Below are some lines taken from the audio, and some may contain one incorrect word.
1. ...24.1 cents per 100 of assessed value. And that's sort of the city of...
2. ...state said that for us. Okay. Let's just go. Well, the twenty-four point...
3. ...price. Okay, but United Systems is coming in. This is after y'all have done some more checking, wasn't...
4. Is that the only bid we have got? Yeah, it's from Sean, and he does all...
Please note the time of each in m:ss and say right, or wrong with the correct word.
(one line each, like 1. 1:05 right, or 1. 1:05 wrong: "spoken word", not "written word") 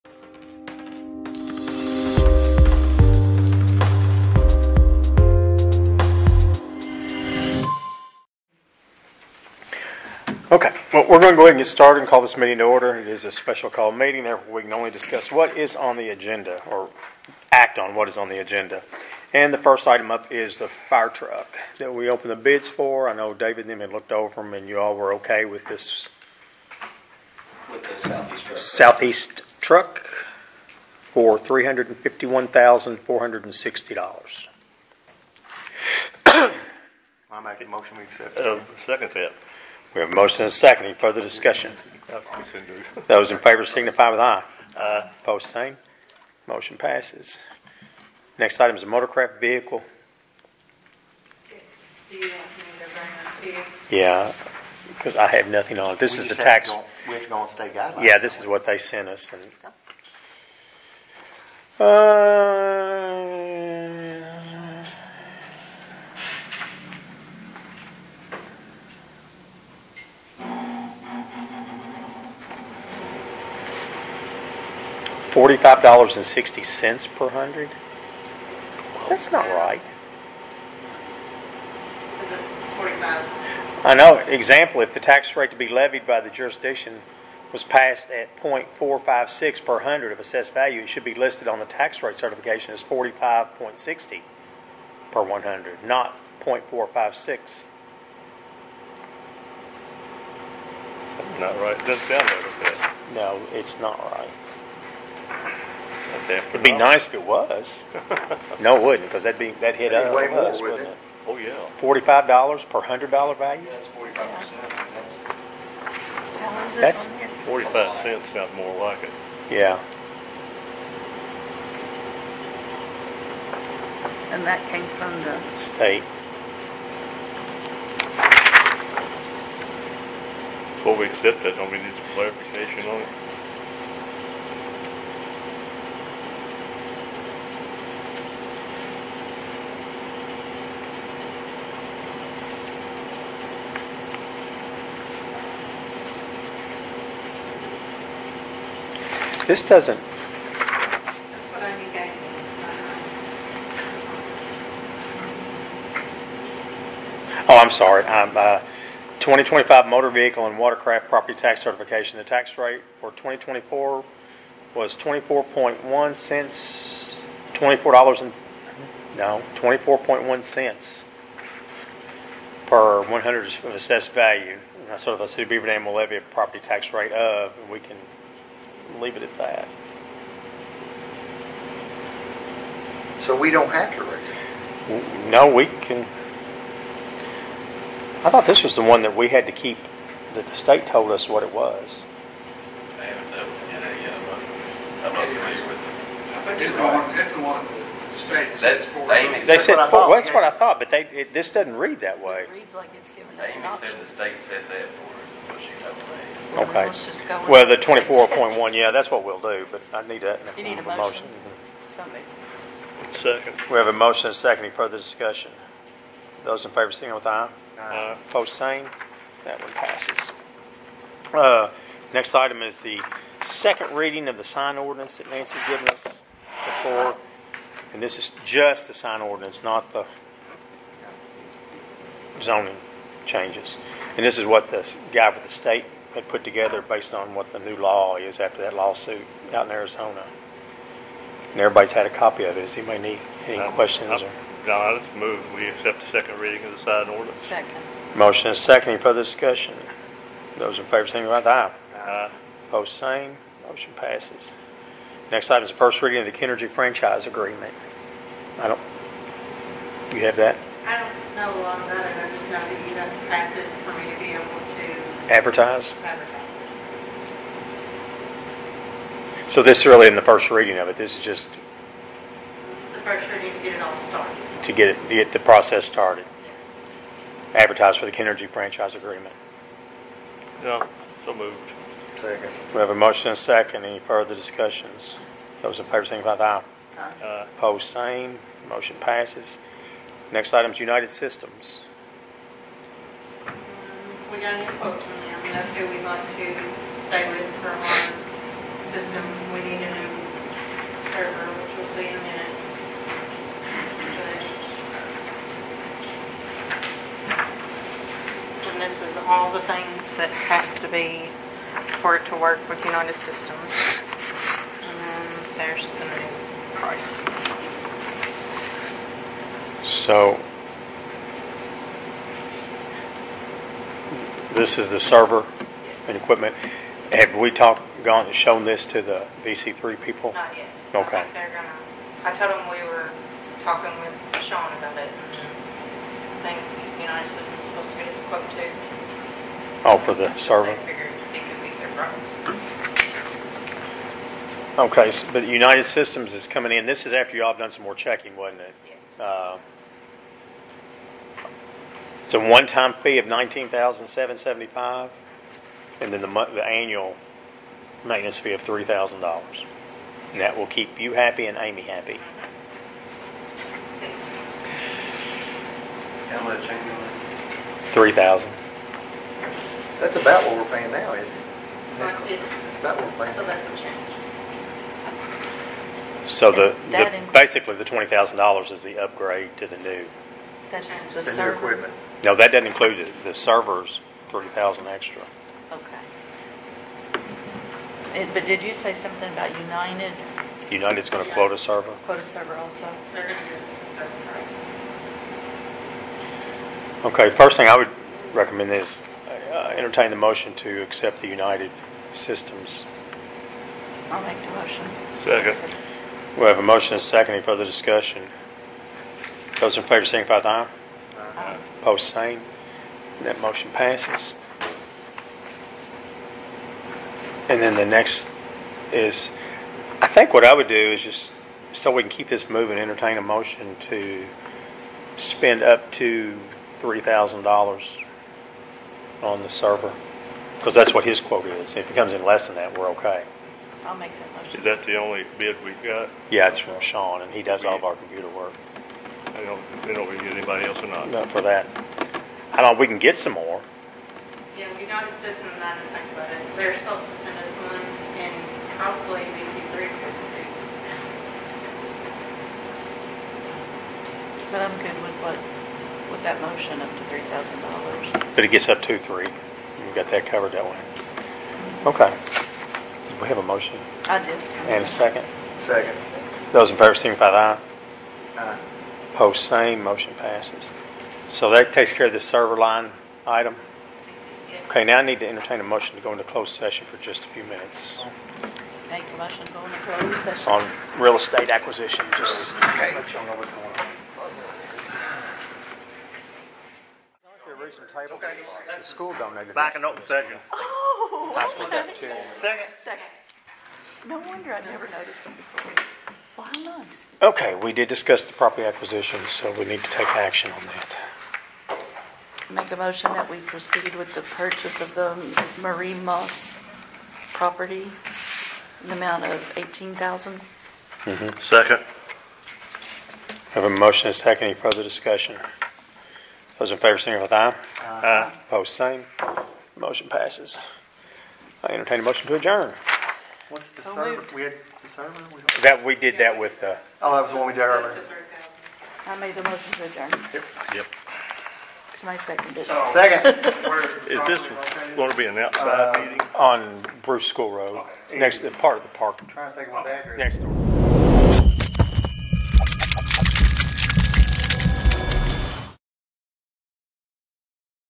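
1. 2:49 right
2. 3:24 right
3. 5:41 right
4. 7:14 right.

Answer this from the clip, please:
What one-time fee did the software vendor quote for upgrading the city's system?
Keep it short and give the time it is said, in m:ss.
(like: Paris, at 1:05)
$19,775, at 5:53.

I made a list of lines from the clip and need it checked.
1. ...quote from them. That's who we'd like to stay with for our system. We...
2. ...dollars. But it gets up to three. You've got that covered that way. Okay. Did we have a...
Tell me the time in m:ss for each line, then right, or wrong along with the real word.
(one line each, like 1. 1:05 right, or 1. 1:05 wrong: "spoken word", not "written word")
1. 4:54 right
2. 7:37 right.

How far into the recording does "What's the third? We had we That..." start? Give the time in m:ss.
8:43.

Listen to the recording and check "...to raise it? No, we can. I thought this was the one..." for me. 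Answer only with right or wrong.
right.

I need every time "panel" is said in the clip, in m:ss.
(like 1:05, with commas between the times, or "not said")
not said.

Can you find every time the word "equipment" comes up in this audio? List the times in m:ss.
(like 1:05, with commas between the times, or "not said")
5:26, 6:21.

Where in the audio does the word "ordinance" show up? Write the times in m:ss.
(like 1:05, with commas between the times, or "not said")
3:44, 3:49, 4:07.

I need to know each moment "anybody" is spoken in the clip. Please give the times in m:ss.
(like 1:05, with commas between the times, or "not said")
4:02, 7:20.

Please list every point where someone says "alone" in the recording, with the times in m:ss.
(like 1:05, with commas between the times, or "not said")
not said.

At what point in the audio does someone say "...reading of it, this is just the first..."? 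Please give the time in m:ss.
4:30.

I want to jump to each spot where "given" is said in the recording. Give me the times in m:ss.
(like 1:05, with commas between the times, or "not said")
3:23, 3:45.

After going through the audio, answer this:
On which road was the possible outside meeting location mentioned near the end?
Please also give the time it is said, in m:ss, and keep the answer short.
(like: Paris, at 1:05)
Bruce School Road, at 8:57.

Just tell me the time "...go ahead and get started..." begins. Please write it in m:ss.
0:11.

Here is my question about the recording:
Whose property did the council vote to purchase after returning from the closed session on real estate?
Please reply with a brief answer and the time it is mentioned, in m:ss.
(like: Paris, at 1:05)
Marie Moss, at 8:25.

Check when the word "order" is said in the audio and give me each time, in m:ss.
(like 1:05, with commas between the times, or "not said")
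0:12.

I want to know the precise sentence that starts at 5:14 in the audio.
And then there's the new price.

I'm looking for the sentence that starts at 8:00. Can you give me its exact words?
On real estate acquisition, just okay.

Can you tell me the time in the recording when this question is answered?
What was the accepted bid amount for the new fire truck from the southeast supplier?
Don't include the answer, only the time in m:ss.
0:31.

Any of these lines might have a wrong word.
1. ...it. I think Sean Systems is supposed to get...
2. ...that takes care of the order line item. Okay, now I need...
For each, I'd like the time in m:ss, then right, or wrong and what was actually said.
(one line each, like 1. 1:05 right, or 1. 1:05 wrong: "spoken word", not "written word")
1. 5:34 wrong: "United", not "Sean"
2. 7:51 wrong: "server", not "order".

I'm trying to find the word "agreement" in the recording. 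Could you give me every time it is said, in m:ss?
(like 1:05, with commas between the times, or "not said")
4:17, 4:38.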